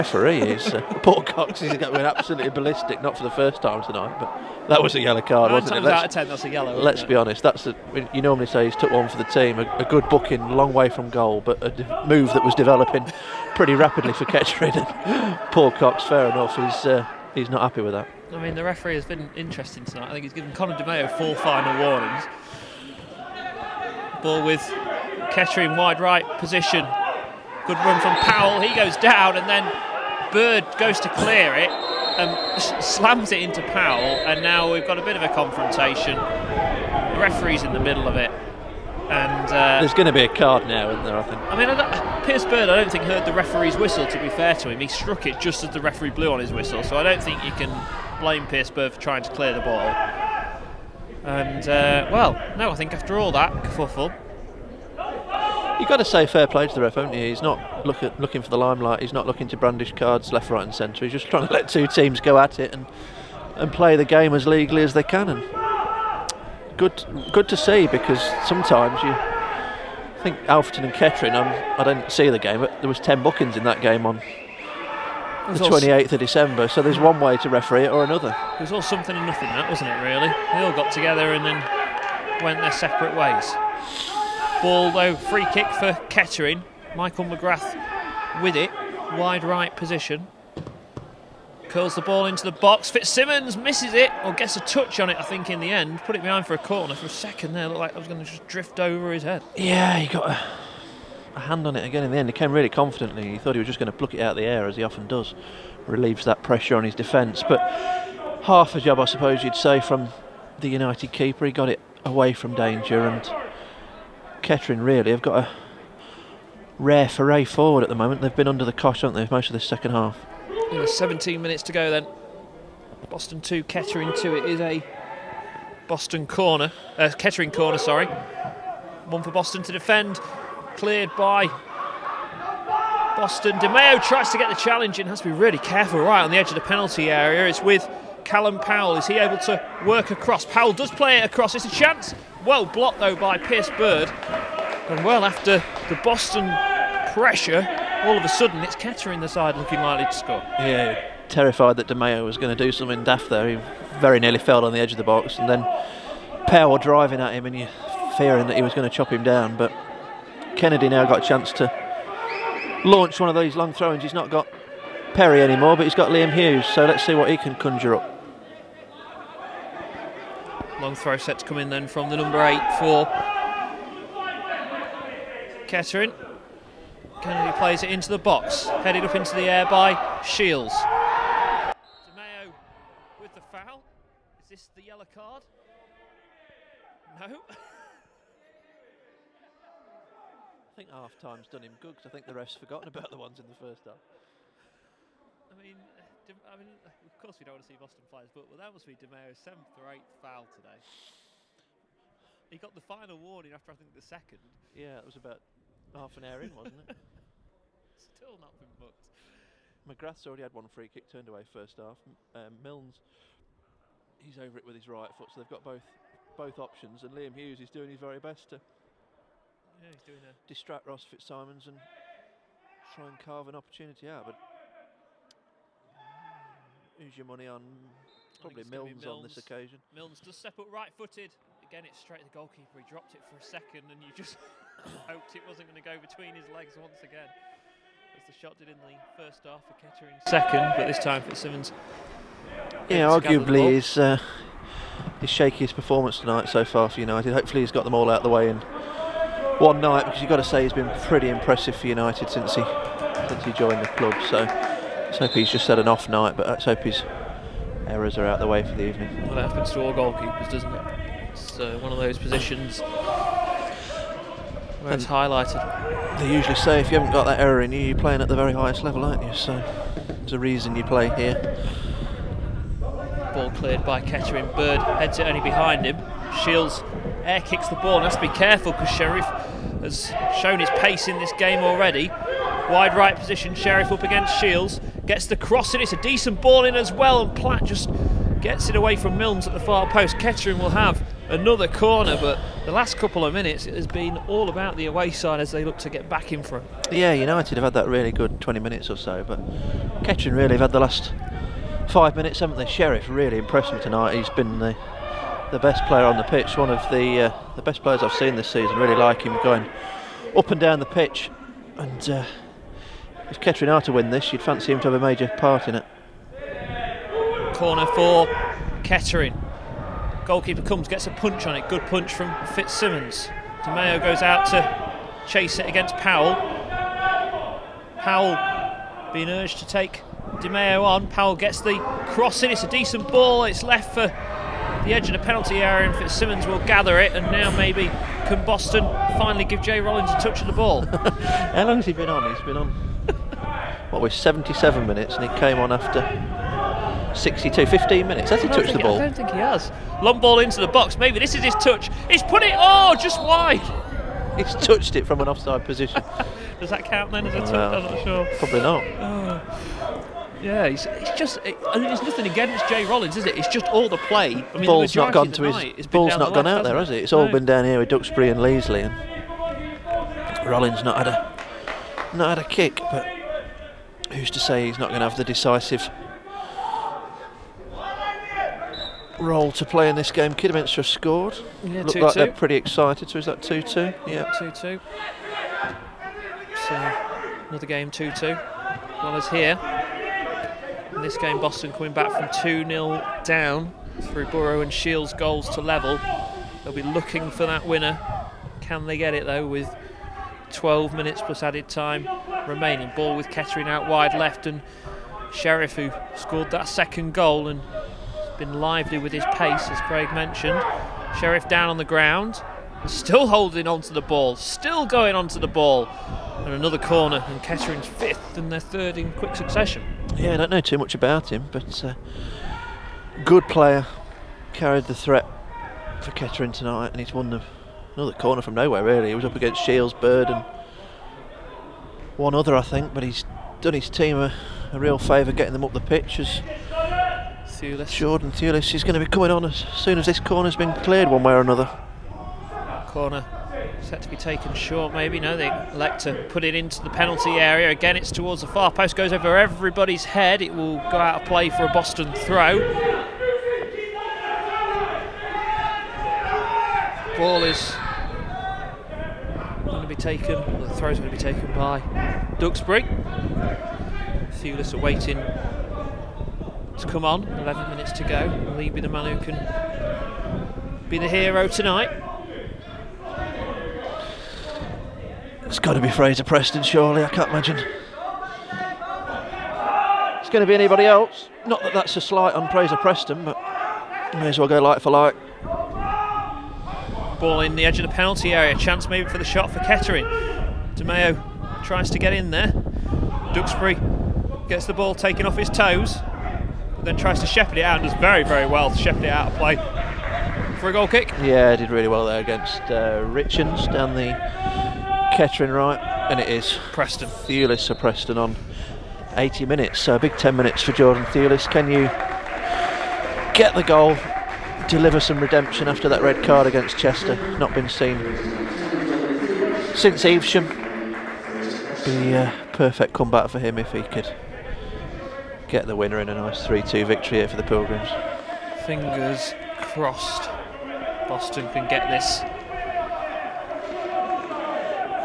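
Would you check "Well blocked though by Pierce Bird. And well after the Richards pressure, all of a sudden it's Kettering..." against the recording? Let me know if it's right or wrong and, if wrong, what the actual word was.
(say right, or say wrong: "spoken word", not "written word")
wrong: "Boston", not "Richards".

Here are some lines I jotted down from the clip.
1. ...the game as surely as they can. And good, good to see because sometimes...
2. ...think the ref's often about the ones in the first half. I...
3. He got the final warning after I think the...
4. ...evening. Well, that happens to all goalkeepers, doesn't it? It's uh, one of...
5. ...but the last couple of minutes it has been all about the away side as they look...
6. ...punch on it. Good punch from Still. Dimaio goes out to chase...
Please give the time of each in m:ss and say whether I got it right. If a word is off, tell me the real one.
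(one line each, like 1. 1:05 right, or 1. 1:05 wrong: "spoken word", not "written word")
1. 1:03 wrong: "legally", not "surely"
2. 3:12 wrong: "forgotten", not "often"
3. 3:22 right
4. 4:18 right
5. 4:52 right
6. 5:21 wrong: "Fitzsimmons", not "Still".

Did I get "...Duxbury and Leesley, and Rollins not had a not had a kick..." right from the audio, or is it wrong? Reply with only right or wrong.
right.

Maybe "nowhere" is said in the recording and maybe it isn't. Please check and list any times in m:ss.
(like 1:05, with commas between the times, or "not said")
7:08.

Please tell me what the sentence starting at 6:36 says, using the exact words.
They'll be looking for that winner.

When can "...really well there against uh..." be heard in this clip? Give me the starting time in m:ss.
8:21.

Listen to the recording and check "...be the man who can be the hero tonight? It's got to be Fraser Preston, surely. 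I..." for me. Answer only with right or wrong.
right.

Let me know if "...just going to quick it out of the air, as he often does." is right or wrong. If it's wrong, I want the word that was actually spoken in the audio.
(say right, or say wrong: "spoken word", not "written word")
wrong: "pluck", not "quick".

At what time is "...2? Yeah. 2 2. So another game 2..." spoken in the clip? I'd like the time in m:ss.
6:23.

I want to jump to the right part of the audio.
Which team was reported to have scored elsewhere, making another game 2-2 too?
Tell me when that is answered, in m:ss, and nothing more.
6:20.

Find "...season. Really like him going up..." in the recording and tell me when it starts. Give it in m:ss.
5:08.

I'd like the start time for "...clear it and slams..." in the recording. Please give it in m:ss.
0:31.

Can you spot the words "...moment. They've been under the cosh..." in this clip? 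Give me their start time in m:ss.
1:57.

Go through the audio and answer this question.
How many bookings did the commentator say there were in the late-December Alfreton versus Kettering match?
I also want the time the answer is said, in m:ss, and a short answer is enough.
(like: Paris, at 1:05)
10, at 1:12.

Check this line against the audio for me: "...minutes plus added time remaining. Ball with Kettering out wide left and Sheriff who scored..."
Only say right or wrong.
right.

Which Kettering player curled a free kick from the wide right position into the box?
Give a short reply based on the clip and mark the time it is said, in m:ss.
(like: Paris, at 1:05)
Michael McGrath, at 1:26.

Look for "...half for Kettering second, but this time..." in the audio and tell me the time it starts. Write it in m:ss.
3:59.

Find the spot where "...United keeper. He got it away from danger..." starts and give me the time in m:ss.
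1:50.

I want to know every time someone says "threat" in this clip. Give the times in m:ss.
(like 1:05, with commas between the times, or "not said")
7:04.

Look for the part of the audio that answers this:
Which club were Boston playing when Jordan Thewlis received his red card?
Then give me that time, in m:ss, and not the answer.
8:36.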